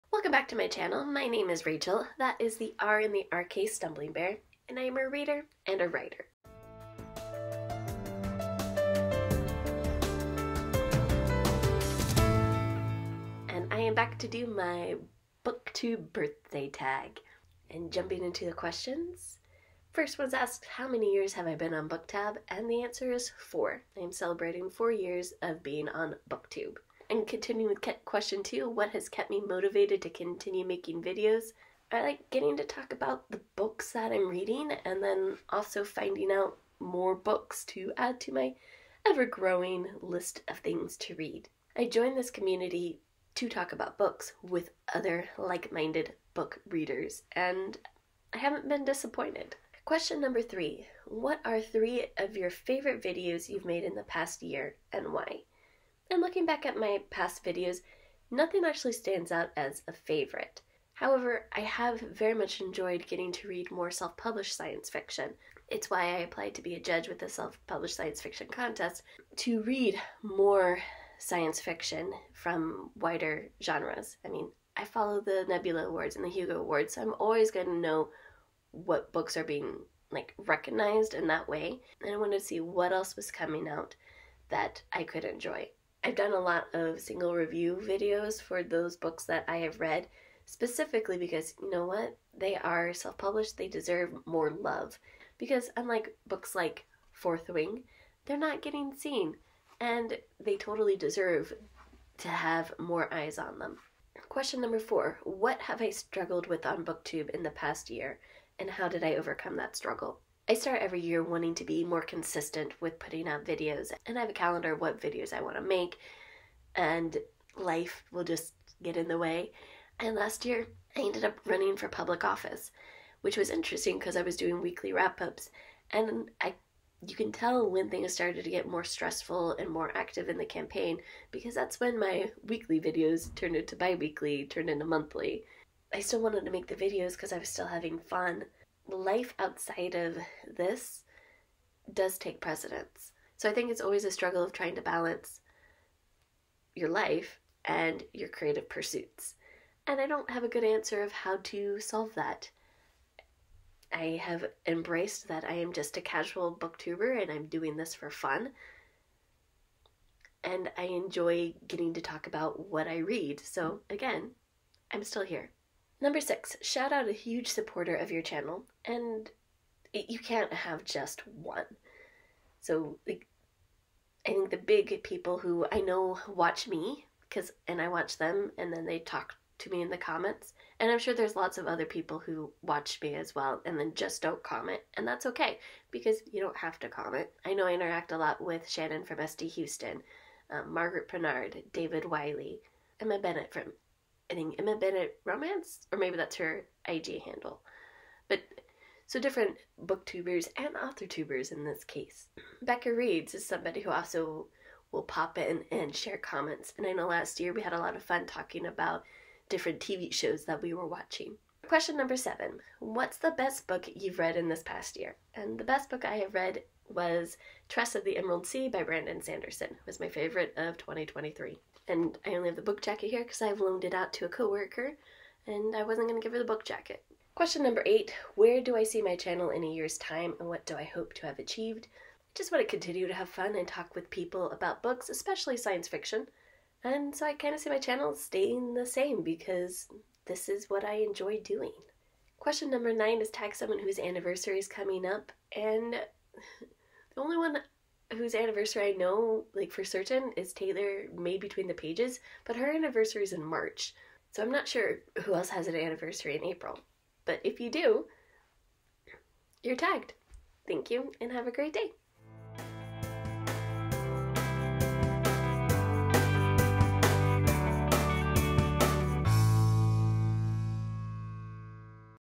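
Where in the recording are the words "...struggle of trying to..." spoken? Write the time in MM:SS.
02:24.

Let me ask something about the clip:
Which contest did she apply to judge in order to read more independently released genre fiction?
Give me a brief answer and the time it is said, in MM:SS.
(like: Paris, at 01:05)
Self published science fiction contest, at 01:07.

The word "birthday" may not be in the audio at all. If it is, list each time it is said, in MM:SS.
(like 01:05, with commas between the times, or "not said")
00:16.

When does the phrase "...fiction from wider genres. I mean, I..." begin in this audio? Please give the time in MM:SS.
01:11.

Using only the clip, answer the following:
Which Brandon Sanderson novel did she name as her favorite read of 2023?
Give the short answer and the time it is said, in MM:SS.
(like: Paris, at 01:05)
Tress of the Emerald Sea, at 03:37.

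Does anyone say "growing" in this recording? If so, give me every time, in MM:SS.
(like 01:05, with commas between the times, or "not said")
00:39.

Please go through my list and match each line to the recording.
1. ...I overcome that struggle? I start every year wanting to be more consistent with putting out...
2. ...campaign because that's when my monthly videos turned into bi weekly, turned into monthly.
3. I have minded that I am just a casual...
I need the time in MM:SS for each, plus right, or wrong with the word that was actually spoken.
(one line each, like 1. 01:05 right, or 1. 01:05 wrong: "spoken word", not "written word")
1. 01:49 right
2. 02:10 wrong: "weekly", not "monthly"
3. 02:33 wrong: "embraced", not "minded".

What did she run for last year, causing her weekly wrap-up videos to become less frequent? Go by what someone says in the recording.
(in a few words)
Public office.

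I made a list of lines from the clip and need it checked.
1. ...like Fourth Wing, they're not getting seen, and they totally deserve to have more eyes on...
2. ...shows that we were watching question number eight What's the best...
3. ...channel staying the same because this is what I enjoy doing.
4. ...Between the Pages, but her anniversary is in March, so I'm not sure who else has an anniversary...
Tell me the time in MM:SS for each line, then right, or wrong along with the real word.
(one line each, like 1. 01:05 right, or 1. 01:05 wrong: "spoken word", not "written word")
1. 01:36 right
2. 03:30 wrong: "seven", not "eight"
3. 03:57 right
4. 04:11 right.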